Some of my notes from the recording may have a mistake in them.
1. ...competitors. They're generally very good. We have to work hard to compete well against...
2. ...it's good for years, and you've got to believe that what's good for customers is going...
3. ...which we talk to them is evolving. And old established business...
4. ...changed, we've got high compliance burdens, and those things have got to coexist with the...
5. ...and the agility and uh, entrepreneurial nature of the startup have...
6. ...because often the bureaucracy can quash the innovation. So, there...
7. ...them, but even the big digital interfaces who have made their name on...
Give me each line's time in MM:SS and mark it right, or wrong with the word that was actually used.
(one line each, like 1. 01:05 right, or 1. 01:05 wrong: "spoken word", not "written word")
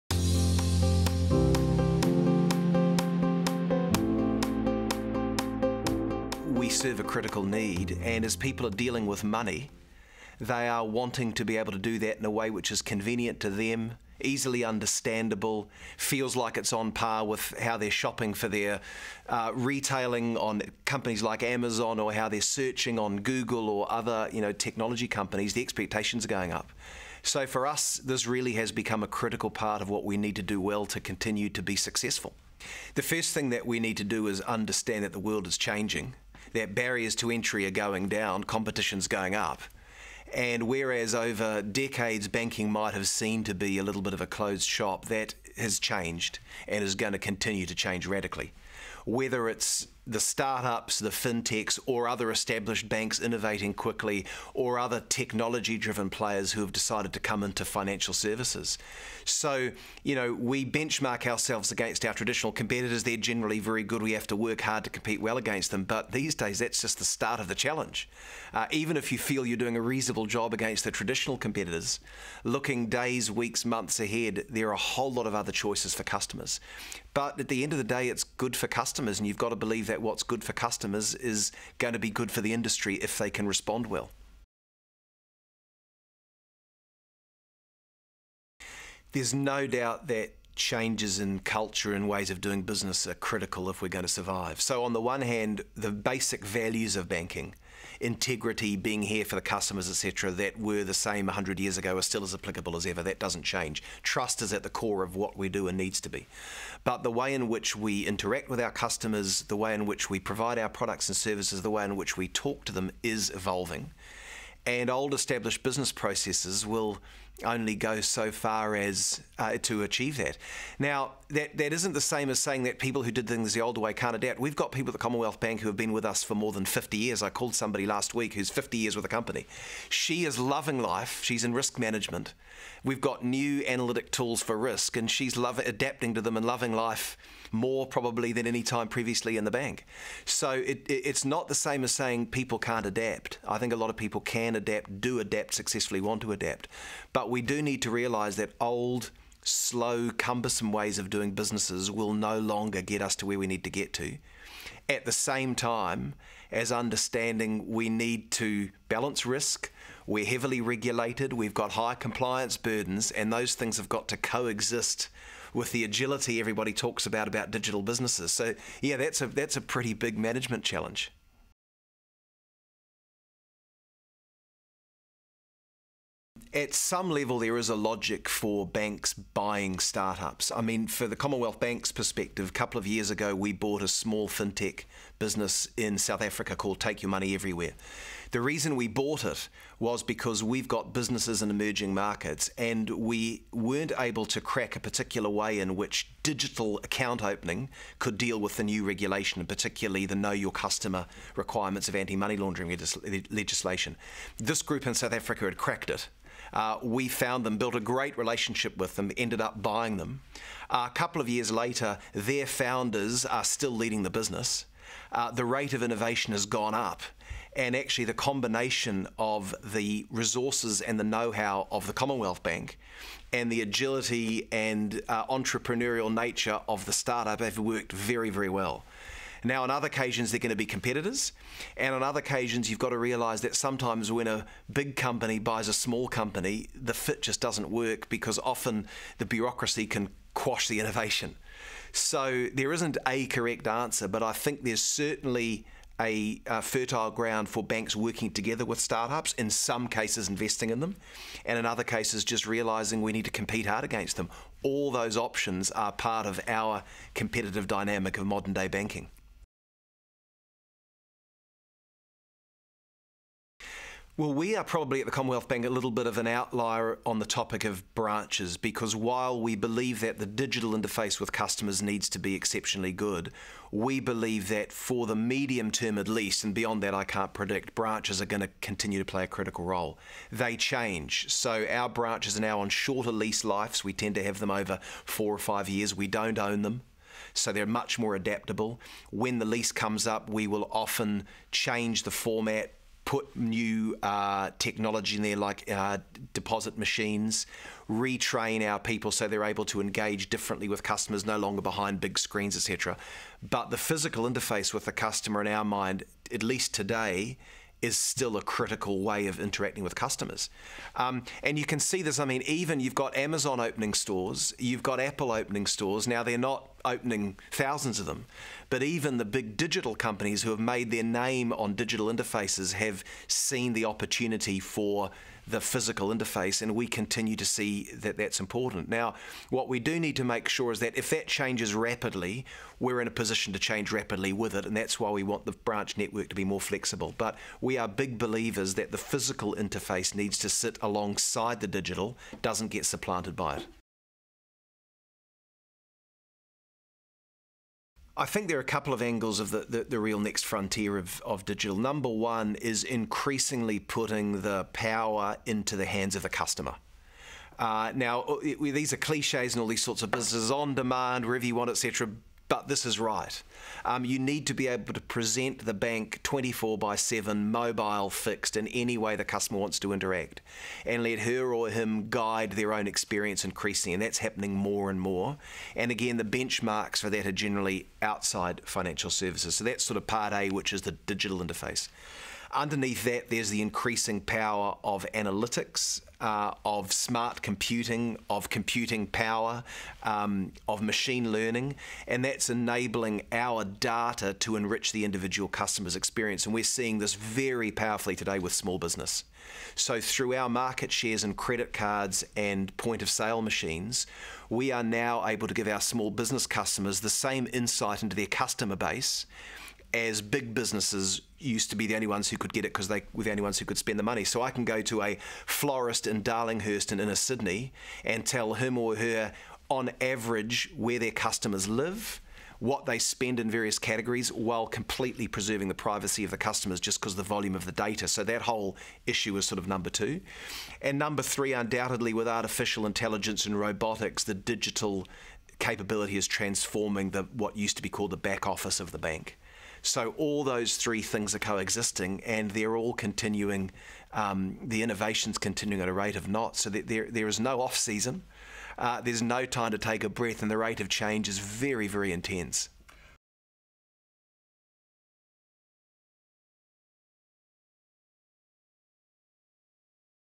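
1. 01:02 right
2. 01:18 wrong: "customers", not "years"
3. 01:51 right
4. 02:40 wrong: "regulated", not "changed"
5. 03:43 right
6. 03:58 right
7. 05:18 wrong: "companies", not "interfaces".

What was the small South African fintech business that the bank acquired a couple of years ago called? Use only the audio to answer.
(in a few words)
Take Your Money Everywhere.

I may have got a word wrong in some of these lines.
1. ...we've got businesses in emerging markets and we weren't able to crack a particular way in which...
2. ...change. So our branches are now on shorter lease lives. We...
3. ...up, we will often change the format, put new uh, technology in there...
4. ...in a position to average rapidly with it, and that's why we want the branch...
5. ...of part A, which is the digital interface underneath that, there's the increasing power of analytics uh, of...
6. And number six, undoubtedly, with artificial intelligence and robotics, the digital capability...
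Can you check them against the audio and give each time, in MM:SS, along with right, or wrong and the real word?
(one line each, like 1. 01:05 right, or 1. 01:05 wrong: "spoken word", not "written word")
1. 03:10 right
2. 04:40 right
3. 04:50 right
4. 05:33 wrong: "change", not "average"
5. 06:19 right
6. 07:10 wrong: "three", not "six".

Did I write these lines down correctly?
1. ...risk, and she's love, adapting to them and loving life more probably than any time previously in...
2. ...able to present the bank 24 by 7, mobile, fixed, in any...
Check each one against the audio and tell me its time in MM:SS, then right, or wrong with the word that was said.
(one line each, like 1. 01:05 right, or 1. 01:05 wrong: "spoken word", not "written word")
1. 02:14 right
2. 06:04 right.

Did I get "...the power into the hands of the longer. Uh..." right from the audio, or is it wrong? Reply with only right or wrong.
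wrong.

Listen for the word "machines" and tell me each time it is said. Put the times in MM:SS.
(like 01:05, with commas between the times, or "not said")
04:56, 06:30, 06:43.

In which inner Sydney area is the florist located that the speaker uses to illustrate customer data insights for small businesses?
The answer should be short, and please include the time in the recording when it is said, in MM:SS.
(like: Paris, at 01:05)
Darlinghurst, at 06:56.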